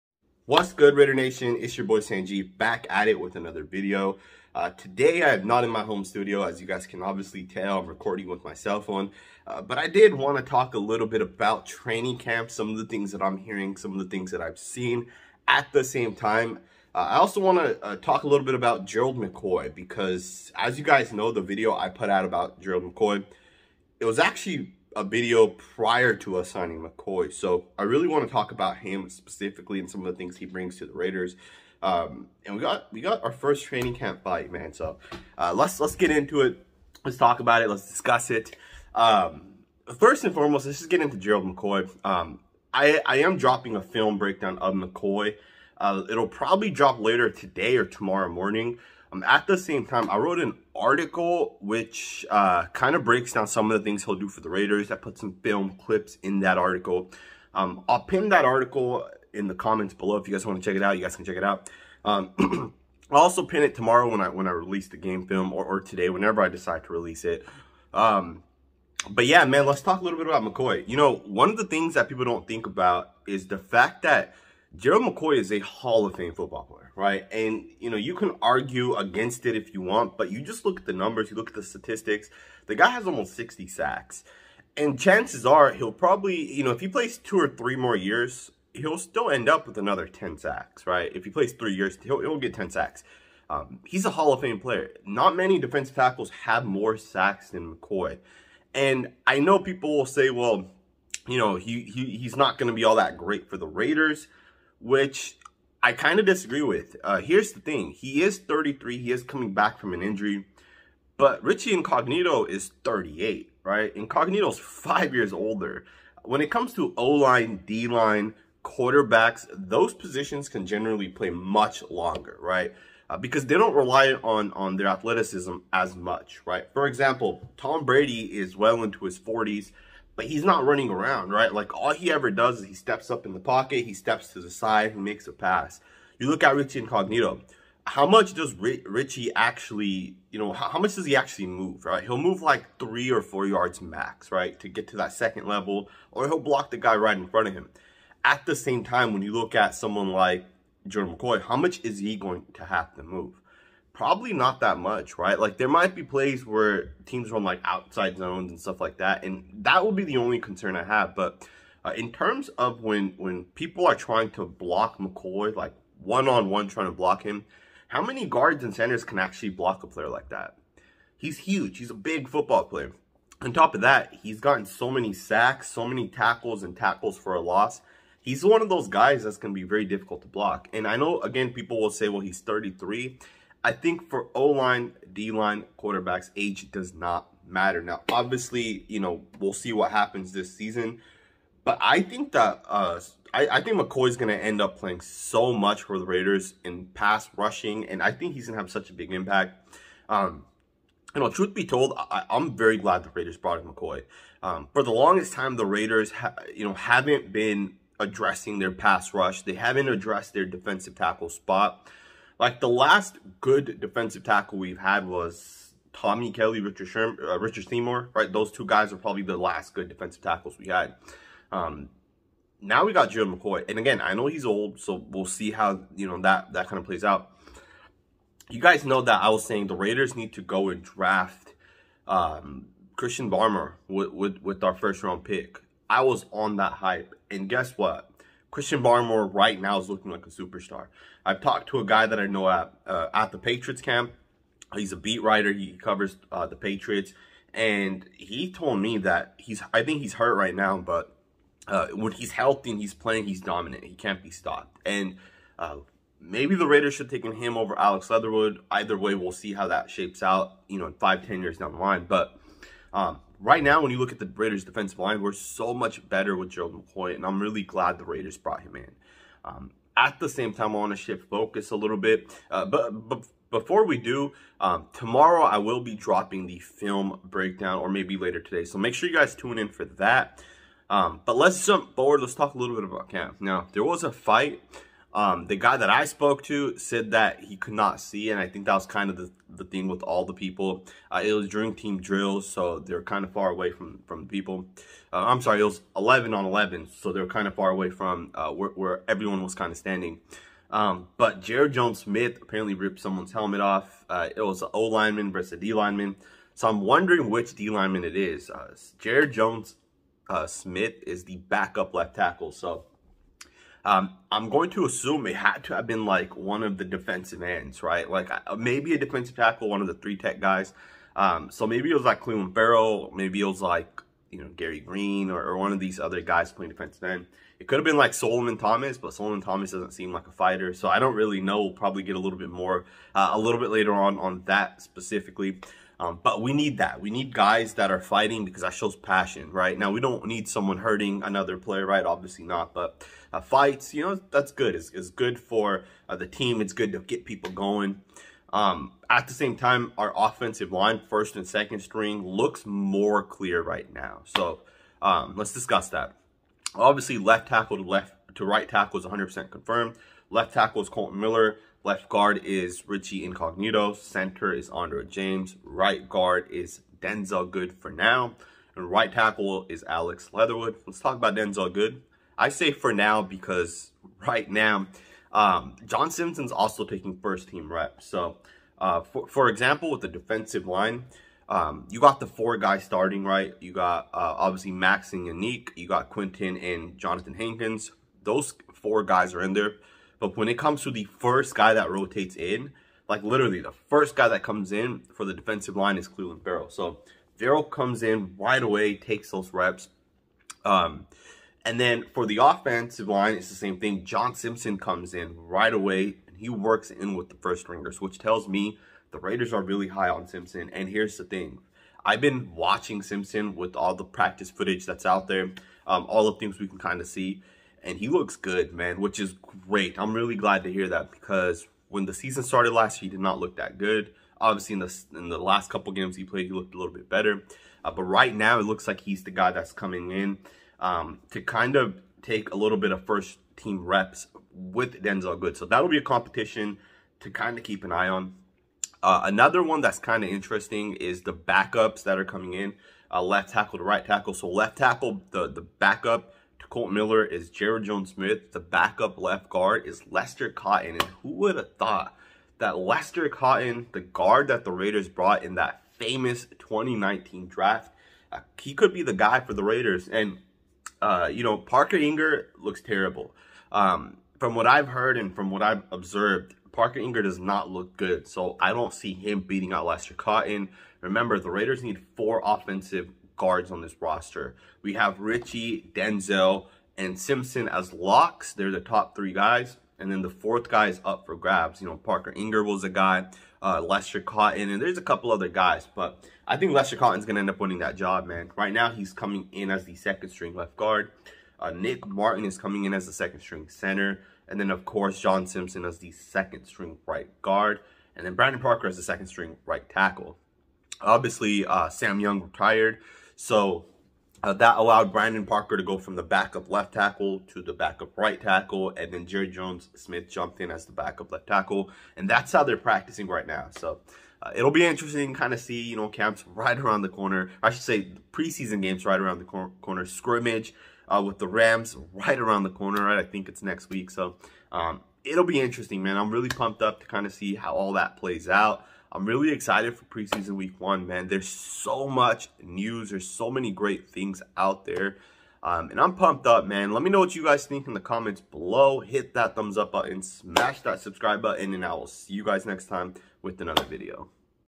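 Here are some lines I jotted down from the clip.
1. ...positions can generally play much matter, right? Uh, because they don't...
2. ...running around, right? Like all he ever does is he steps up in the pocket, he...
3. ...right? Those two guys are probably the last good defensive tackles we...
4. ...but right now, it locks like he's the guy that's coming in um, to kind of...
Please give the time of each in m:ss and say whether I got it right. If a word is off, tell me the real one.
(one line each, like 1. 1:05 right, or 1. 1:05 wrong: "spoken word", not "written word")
1. 1:59 wrong: "longer", not "matter"
2. 2:10 right
3. 3:38 right
4. 7:07 wrong: "looks", not "locks".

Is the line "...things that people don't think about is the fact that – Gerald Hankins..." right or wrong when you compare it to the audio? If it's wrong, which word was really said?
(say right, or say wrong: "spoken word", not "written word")
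wrong: "McCoy", not "Hankins".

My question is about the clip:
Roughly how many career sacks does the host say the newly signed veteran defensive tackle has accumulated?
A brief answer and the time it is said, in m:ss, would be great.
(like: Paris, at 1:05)
almost 60, at 1:23.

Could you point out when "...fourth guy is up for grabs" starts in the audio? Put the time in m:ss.
8:00.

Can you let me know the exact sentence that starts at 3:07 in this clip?
Now, obviously, you know, we'll see what happens this season.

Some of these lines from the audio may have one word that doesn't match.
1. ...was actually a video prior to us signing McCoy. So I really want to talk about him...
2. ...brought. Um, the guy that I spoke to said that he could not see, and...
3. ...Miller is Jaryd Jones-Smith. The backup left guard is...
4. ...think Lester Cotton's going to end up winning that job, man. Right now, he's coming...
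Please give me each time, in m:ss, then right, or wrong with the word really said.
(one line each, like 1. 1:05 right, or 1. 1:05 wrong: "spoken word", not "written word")
1. 0:24 right
2. 4:44 wrong: "fight", not "brought"
3. 7:26 right
4. 8:06 right.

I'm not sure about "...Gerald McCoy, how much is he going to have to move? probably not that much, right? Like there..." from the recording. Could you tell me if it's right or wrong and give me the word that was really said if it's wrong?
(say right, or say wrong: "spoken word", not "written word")
right.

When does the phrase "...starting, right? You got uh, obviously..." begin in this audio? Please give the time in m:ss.
6:22.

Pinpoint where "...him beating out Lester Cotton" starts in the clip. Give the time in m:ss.
7:49.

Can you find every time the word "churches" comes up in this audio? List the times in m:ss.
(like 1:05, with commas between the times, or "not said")
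not said.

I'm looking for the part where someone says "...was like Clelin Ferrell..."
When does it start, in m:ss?
5:21.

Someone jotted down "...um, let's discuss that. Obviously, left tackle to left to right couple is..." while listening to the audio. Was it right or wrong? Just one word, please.
wrong.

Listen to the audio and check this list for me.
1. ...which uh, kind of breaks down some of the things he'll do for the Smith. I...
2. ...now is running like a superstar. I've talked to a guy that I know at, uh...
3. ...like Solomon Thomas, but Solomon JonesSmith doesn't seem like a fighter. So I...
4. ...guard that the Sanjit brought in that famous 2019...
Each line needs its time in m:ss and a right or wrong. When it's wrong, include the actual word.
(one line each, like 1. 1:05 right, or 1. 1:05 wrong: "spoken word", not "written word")
1. 0:51 wrong: "Raiders", not "Smith"
2. 3:59 wrong: "looking", not "running"
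3. 5:27 wrong: "Thomas", not "JonesSmith"
4. 7:34 wrong: "Raiders", not "Sanjit".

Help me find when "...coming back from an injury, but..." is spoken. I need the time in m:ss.
1:49.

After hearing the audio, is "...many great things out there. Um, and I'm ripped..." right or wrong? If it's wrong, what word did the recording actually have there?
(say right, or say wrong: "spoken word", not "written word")
wrong: "pumped", not "ripped".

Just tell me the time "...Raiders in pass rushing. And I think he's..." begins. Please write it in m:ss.
3:16.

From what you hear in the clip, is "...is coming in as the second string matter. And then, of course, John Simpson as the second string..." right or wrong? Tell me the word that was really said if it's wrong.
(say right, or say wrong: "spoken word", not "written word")
wrong: "center", not "matter".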